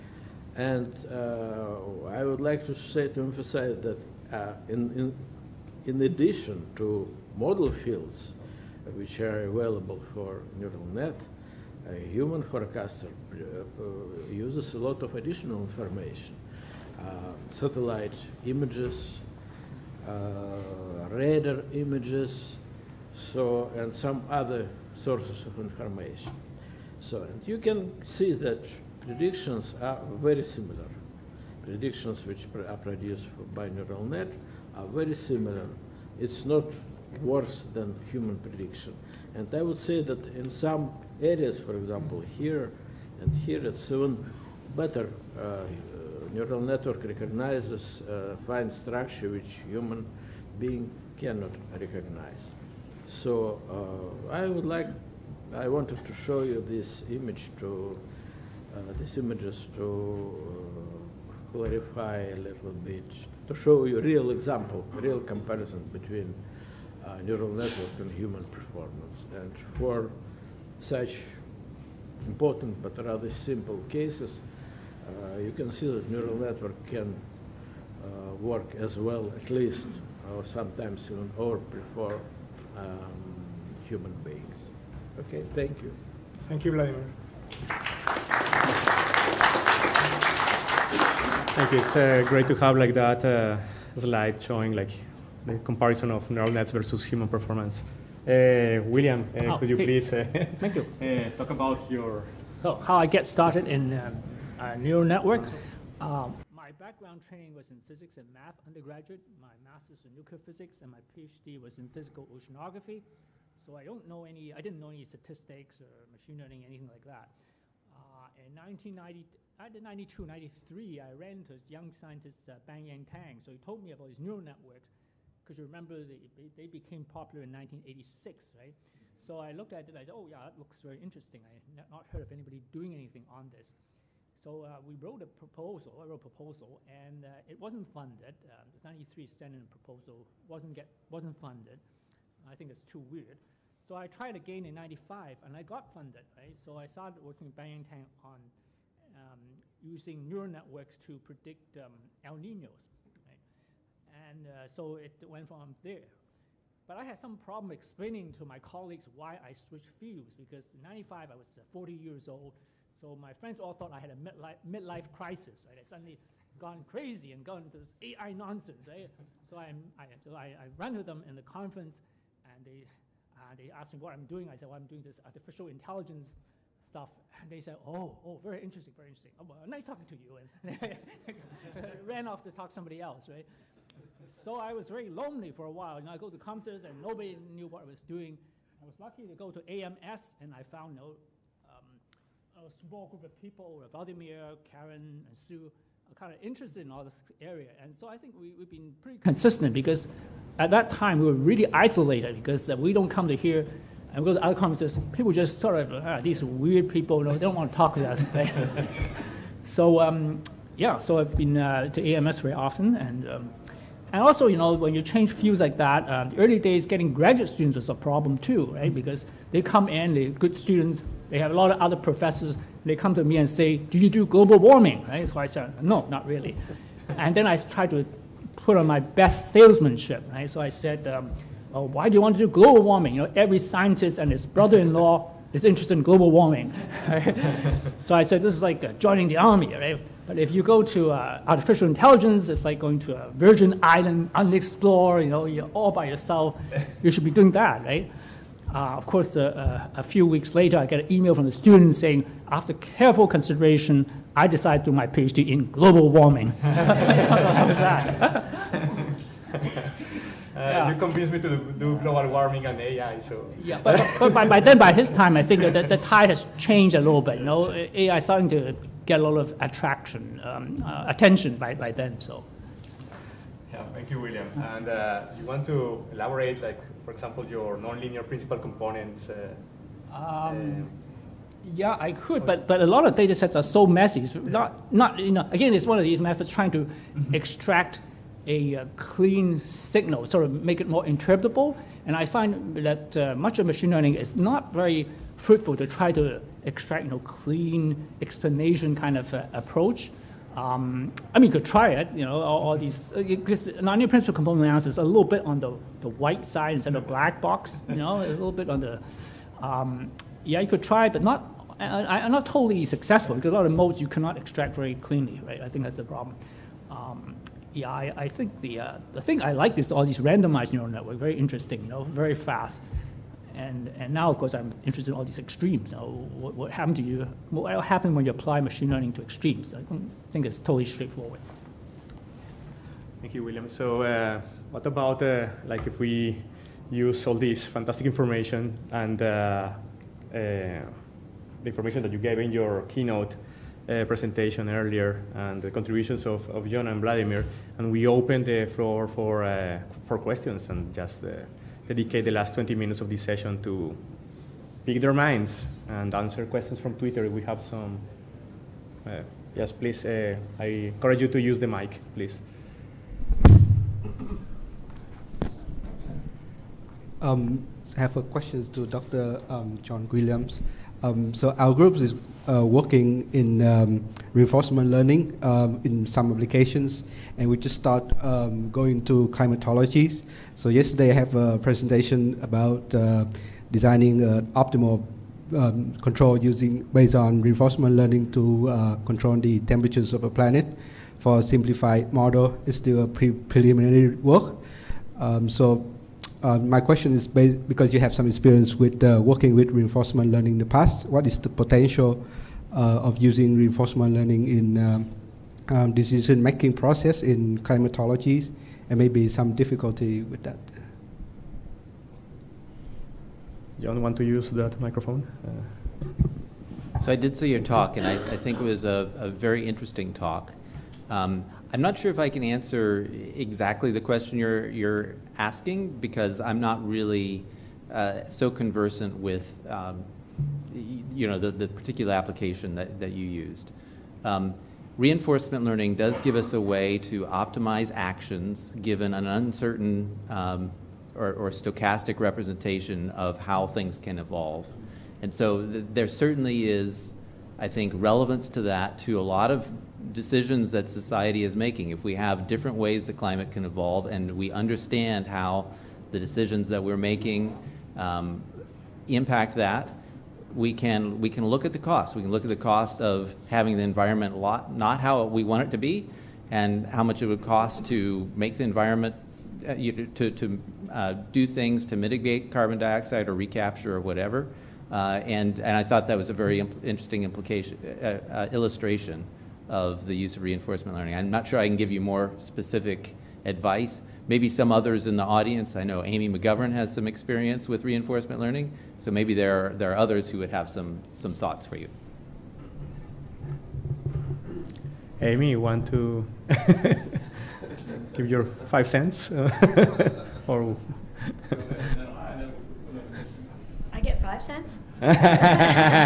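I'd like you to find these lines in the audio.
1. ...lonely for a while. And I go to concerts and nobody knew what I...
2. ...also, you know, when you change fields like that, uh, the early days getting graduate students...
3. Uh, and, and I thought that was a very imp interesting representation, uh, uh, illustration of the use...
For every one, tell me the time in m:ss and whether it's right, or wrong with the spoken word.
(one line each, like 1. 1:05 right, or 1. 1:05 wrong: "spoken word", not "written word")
1. 3:05 right
2. 3:34 right
3. 7:54 wrong: "implication", not "representation".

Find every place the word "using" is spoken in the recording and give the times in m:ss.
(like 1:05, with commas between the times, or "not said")
2:29, 6:26, 6:43.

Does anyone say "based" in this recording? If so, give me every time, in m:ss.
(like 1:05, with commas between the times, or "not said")
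6:26, 6:37.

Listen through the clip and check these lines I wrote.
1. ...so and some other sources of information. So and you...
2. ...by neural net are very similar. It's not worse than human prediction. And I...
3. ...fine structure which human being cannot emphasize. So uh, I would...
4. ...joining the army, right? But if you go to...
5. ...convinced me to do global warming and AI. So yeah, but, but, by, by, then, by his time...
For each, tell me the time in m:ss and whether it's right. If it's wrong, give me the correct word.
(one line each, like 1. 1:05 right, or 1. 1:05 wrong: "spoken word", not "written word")
1. 0:23 right
2. 0:33 right
3. 0:48 wrong: "recognize", not "emphasize"
4. 3:58 right
5. 4:20 right.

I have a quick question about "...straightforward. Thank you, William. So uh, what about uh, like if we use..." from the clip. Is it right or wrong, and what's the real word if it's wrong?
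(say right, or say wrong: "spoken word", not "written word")
right.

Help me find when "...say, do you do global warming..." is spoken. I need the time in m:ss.
3:43.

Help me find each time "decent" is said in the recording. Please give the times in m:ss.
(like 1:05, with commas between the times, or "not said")
not said.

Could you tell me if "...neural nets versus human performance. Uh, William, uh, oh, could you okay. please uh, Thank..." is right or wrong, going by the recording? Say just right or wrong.
right.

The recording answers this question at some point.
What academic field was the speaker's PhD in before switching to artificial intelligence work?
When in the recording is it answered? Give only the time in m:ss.
1:51.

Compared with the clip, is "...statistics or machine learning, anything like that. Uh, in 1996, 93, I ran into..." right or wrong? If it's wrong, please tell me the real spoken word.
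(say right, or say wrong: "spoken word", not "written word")
wrong: "1992", not "1996".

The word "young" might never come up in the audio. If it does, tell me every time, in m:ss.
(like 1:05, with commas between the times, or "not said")
2:01.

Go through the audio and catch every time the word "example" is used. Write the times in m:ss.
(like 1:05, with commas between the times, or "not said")
0:41, 1:04, 4:37.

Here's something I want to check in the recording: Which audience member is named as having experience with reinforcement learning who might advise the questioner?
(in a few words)
Amy McGovern.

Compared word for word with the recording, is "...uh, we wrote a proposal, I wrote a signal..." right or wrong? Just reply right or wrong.
wrong.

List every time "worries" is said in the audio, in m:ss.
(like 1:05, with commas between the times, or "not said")
not said.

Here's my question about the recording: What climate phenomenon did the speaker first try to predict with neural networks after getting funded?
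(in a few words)
El Ninos.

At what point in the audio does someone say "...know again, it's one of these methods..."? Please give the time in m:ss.
4:45.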